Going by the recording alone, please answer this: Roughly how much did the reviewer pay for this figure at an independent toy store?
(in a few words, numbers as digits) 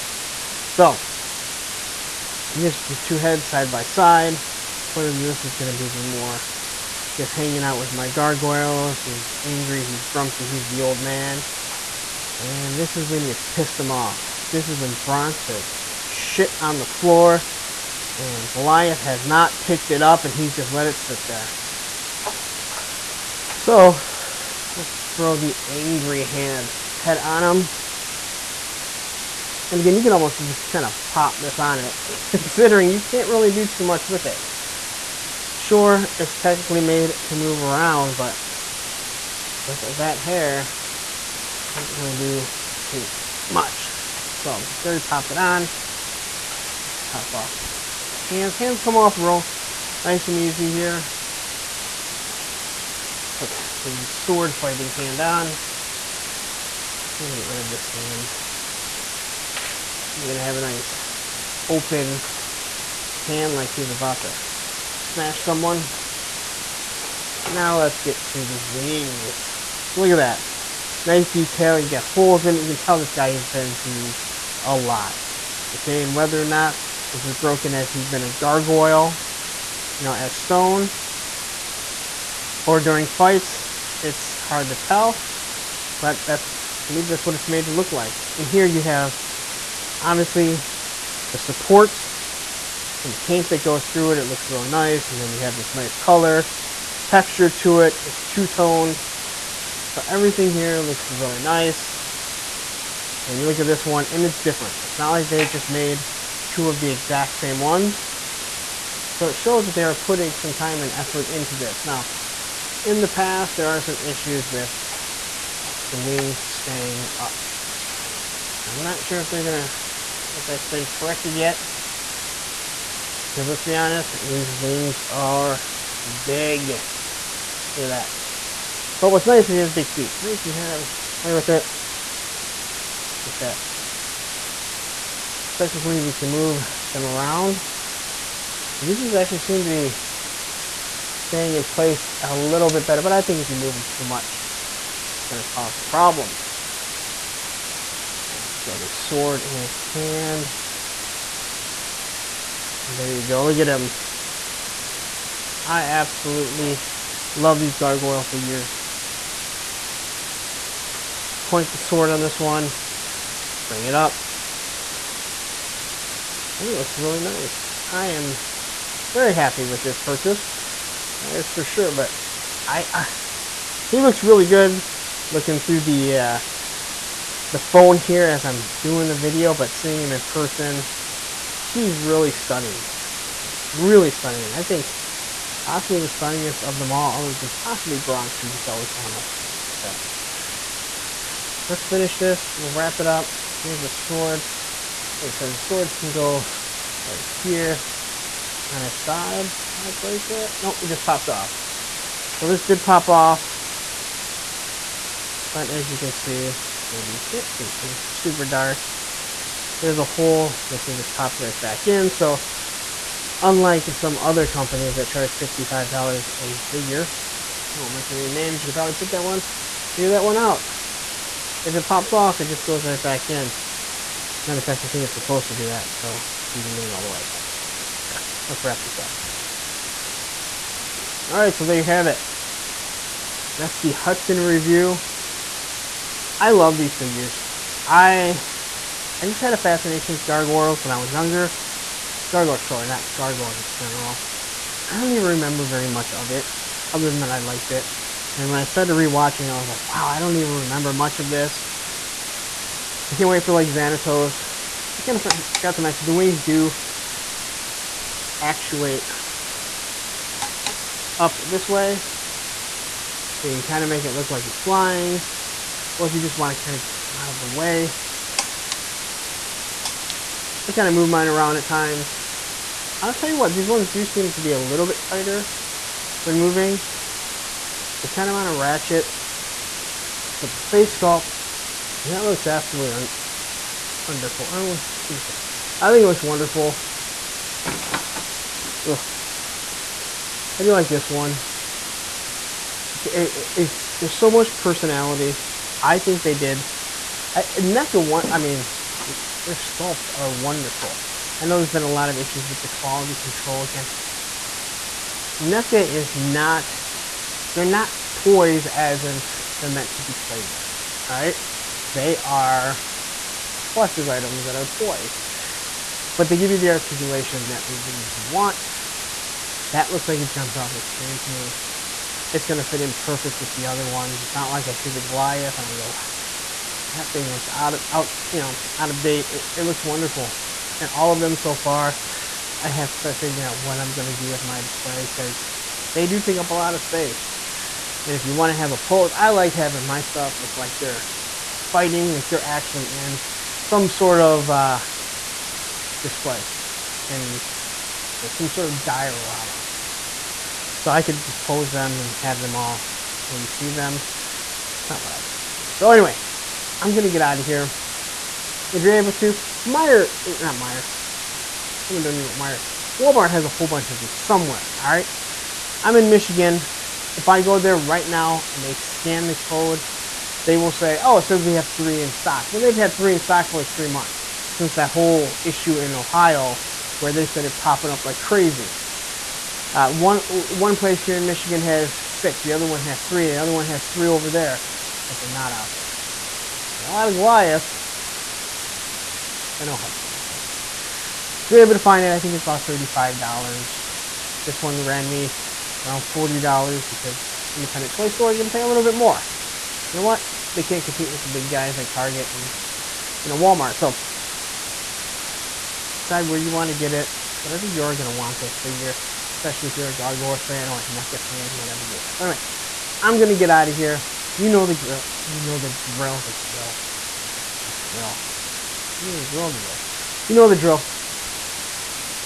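$40.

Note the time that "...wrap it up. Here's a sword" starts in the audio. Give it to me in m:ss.
3:12.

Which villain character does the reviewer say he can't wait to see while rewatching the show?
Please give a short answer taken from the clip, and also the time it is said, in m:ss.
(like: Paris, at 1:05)
Xanatos, at 4:13.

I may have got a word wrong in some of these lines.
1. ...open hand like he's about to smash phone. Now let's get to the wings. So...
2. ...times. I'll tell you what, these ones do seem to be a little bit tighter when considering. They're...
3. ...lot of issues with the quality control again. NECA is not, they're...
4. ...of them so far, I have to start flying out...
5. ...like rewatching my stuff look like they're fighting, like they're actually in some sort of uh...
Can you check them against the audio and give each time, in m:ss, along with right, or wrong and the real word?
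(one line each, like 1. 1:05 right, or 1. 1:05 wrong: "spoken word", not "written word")
1. 1:01 wrong: "someone", not "phone"
2. 4:31 wrong: "moving", not "considering"
3. 5:01 right
4. 5:31 wrong: "figuring", not "flying"
5. 5:39 wrong: "having", not "rewatching".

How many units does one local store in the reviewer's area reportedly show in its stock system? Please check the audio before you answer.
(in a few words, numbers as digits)
6.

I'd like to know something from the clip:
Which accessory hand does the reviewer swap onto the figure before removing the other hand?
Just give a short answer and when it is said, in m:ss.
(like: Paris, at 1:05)
Sword fighting hand, at 0:54.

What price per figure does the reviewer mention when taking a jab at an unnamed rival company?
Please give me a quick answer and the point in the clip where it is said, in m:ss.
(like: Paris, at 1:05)
$55, at 3:35.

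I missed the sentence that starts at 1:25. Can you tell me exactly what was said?
But that's believe that's what it's made to look like.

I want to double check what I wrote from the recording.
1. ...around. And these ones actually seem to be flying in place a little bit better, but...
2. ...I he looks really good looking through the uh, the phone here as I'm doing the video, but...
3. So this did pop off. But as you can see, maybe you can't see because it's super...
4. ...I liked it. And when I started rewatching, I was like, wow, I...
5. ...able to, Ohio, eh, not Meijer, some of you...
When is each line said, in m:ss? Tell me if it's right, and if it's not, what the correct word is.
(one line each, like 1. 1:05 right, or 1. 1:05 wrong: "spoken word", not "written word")
1. 2:17 wrong: "staying", not "flying"
2. 2:52 right
3. 3:22 right
4. 4:07 right
5. 5:58 wrong: "Meijer", not "Ohio".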